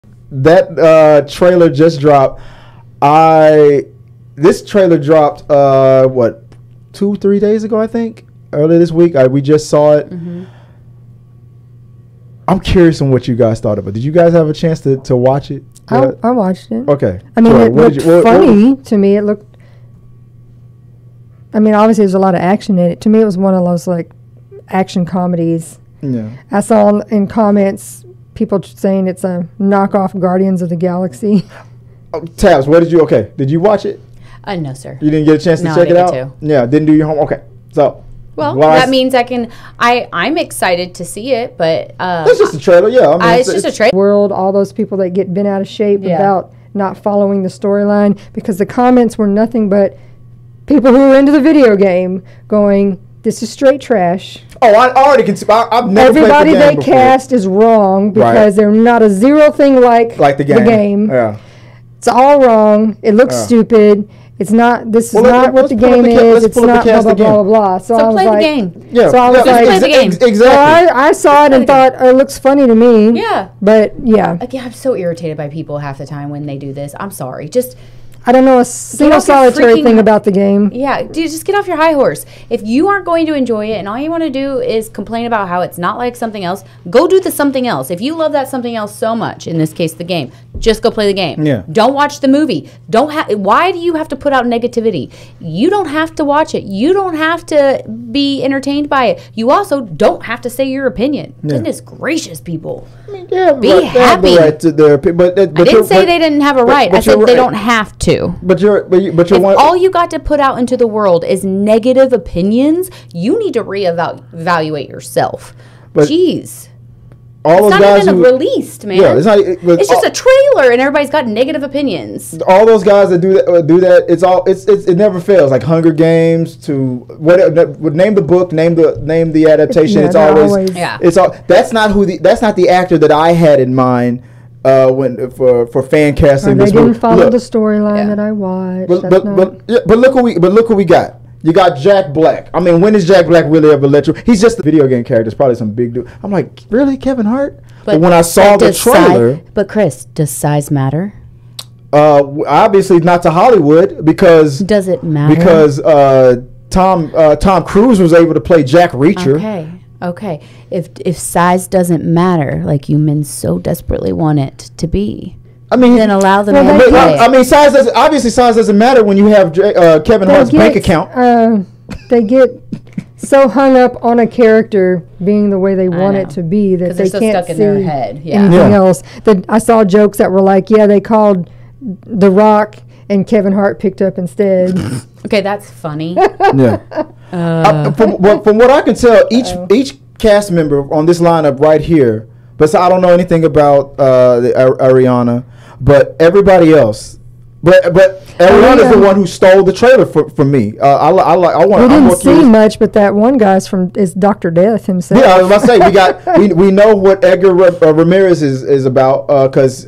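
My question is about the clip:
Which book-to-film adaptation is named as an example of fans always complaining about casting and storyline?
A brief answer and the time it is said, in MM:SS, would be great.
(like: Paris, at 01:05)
Hunger Games, at 02:05.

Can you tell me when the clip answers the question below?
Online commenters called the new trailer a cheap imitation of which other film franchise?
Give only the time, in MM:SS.
00:30.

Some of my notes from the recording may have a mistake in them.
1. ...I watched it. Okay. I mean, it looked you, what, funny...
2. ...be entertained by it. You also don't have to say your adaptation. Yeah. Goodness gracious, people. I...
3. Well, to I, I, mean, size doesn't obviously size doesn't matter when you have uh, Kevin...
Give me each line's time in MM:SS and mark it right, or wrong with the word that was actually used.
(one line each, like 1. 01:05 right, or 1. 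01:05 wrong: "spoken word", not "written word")
1. 00:16 right
2. 01:38 wrong: "opinion", not "adaptation"
3. 02:46 right.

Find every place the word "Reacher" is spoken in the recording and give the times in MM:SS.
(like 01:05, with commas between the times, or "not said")
02:38.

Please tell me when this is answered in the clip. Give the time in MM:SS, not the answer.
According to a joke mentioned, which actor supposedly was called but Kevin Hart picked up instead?
03:02.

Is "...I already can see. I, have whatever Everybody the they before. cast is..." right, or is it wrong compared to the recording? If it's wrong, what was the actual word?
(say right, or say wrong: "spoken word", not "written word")
wrong: "never", not "whatever".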